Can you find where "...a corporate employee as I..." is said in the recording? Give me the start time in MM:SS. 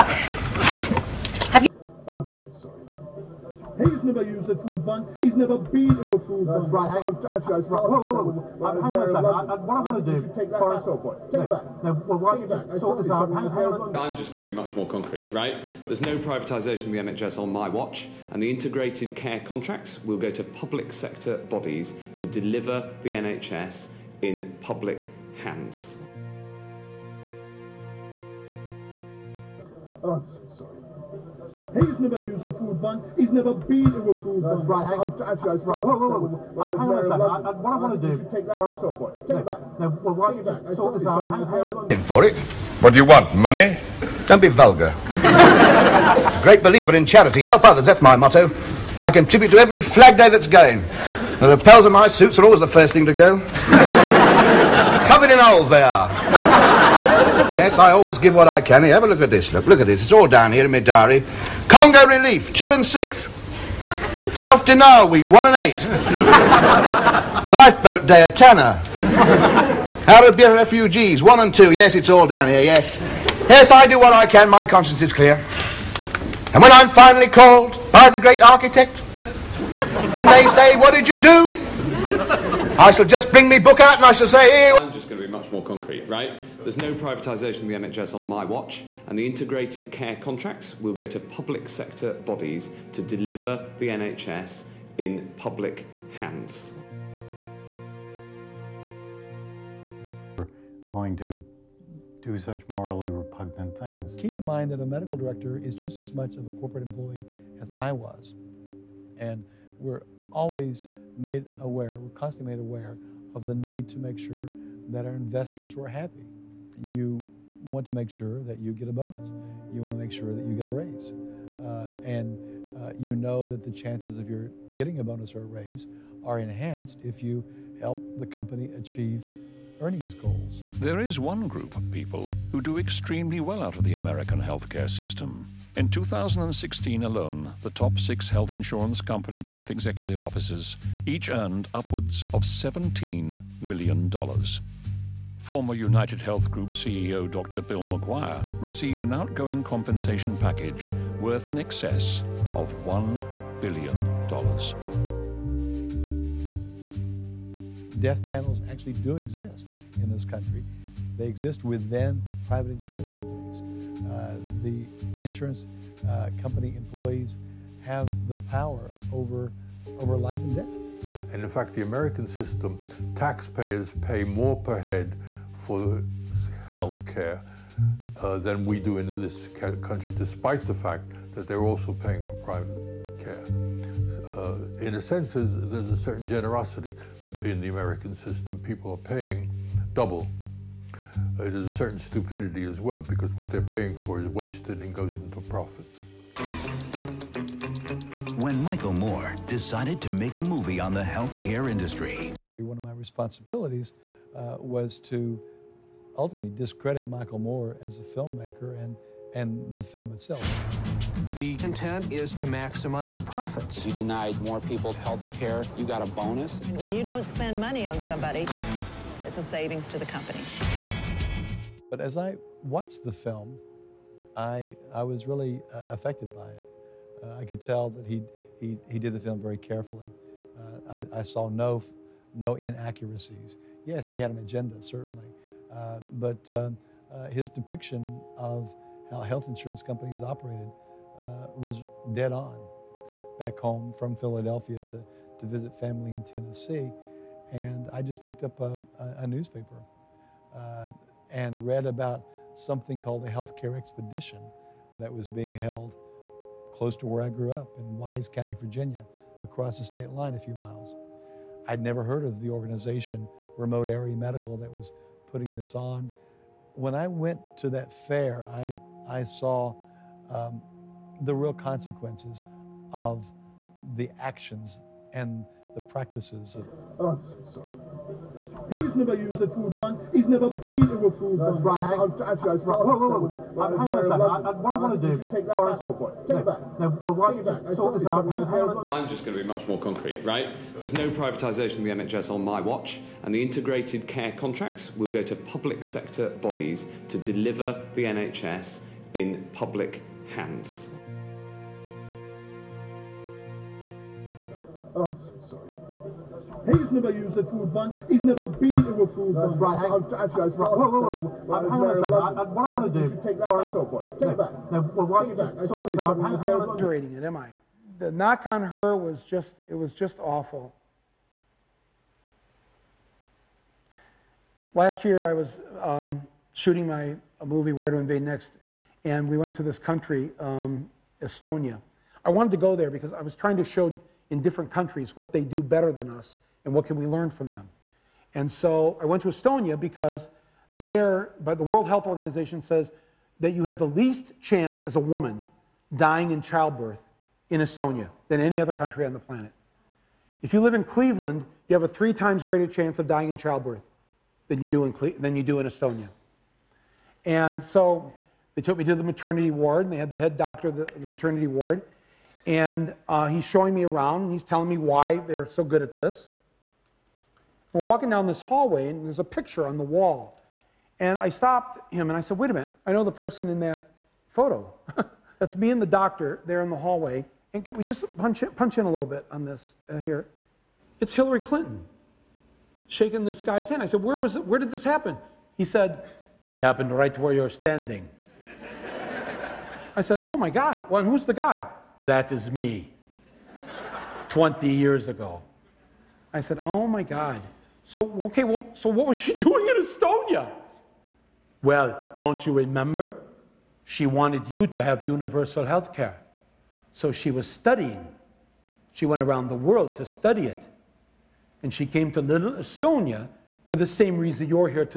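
01:46.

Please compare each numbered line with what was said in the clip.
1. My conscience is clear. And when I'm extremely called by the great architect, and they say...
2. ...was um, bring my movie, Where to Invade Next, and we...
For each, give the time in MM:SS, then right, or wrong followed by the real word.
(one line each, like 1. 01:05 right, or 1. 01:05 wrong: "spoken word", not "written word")
1. 01:14 wrong: "finally", not "extremely"
2. 05:25 wrong: "shooting", not "bring".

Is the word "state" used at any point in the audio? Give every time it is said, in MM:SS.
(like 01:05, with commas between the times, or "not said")
04:19.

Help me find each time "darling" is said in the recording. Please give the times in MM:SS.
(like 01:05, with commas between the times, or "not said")
not said.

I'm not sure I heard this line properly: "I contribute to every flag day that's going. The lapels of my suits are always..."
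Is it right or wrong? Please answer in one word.
right.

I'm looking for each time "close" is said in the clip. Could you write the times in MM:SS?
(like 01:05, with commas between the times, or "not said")
04:16.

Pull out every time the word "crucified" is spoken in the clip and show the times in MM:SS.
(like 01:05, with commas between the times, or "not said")
not said.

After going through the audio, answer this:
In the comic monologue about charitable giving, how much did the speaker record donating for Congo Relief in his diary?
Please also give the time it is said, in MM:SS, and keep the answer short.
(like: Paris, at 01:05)
two and six, at 01:02.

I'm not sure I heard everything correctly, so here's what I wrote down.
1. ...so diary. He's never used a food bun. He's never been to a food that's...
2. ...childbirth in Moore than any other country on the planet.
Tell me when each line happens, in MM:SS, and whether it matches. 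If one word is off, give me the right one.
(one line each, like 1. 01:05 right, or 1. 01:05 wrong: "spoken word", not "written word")
1. 05:05 wrong: "sorry", not "diary"
2. 05:46 wrong: "Estonia", not "Moore".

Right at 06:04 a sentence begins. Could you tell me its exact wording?
He's telling me why they're so good at this.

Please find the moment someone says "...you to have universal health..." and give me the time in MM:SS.
06:44.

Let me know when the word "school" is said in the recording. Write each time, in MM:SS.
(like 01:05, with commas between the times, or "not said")
not said.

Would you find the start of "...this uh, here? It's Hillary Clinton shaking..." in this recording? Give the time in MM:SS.
06:19.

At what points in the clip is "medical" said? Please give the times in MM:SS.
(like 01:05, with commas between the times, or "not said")
01:44, 04:24.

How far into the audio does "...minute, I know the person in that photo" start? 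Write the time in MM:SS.
06:12.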